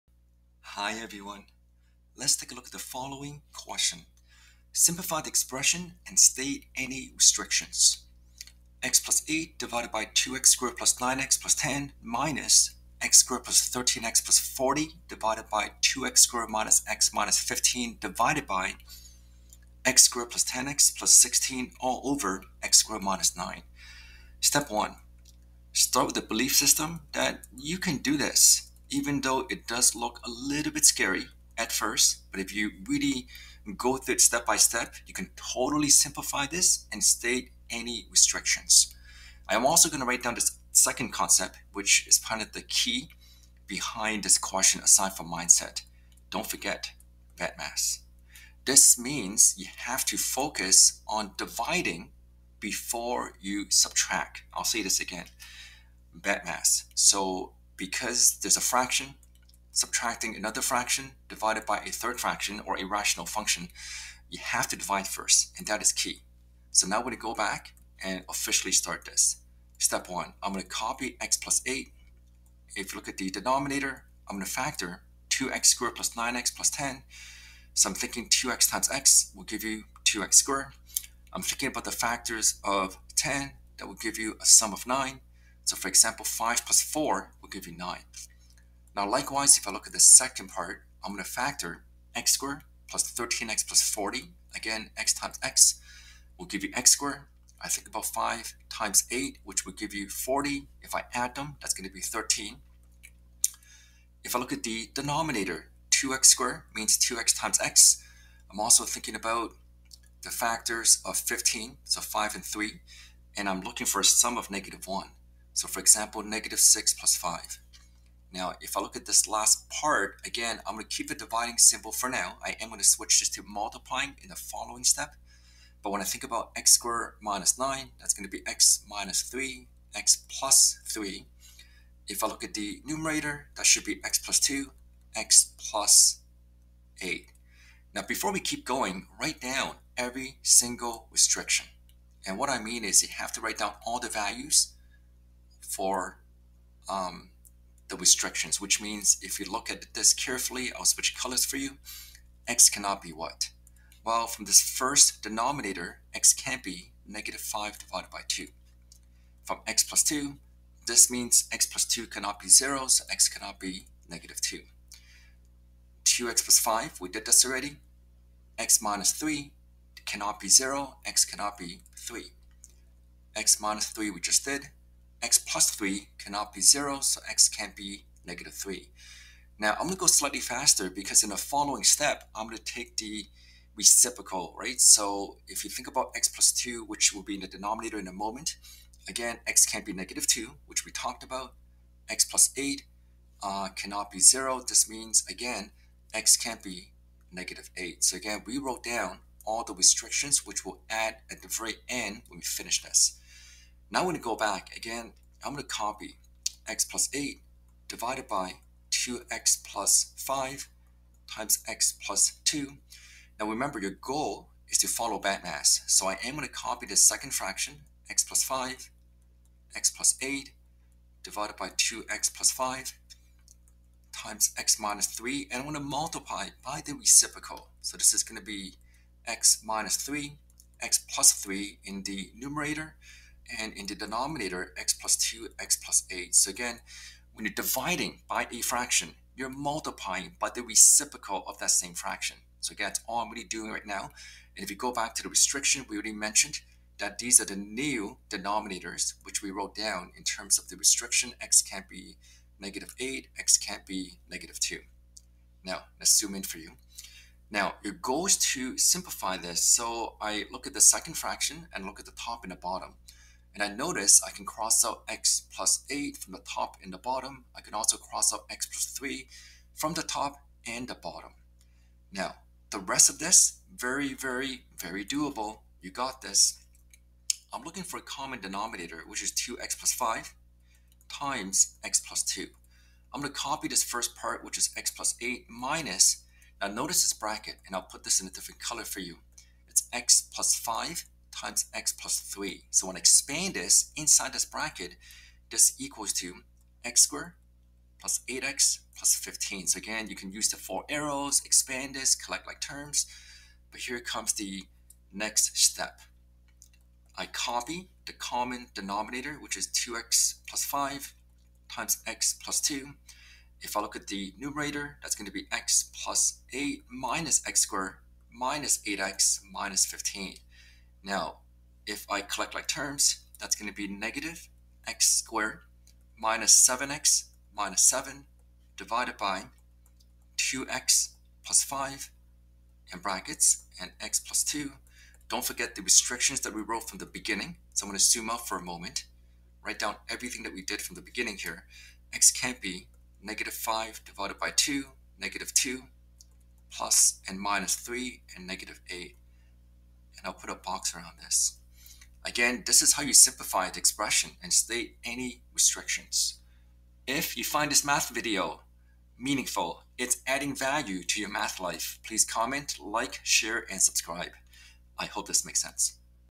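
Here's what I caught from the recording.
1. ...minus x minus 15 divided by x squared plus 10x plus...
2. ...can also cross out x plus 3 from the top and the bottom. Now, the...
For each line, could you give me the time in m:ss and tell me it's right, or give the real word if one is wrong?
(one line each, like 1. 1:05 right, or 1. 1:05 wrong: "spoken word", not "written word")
1. 0:16 right
2. 4:27 right.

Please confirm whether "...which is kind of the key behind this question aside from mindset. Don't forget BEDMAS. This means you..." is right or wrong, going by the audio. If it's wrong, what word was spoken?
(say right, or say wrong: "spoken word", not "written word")
right.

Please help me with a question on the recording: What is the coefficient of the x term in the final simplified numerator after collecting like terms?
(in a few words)
-7.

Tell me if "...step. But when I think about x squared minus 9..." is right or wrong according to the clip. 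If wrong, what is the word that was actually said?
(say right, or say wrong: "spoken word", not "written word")
right.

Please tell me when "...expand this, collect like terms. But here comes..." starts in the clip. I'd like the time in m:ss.
5:01.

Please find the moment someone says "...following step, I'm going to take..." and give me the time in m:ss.
3:01.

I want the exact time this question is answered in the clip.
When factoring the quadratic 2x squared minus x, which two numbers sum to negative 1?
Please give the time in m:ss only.
1:56.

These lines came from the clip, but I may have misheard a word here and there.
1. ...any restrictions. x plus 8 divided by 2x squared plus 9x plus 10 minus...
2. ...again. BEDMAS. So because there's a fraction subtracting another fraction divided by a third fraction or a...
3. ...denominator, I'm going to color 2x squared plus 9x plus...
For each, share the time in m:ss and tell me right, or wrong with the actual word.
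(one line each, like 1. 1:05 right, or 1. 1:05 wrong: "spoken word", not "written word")
1. 0:06 right
2. 0:54 right
3. 1:13 wrong: "factor", not "color".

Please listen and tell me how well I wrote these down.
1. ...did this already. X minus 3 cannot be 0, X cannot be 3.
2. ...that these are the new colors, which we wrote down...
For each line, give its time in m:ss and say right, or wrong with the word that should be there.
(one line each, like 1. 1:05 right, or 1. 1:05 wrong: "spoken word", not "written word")
1. 2:47 right
2. 4:06 wrong: "denominators", not "colors".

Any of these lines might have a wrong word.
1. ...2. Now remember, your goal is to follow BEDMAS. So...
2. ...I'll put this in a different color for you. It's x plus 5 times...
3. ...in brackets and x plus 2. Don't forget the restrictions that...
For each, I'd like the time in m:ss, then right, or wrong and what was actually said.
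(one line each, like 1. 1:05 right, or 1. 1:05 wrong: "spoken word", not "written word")
1. 3:32 right
2. 4:47 right
3. 5:32 right.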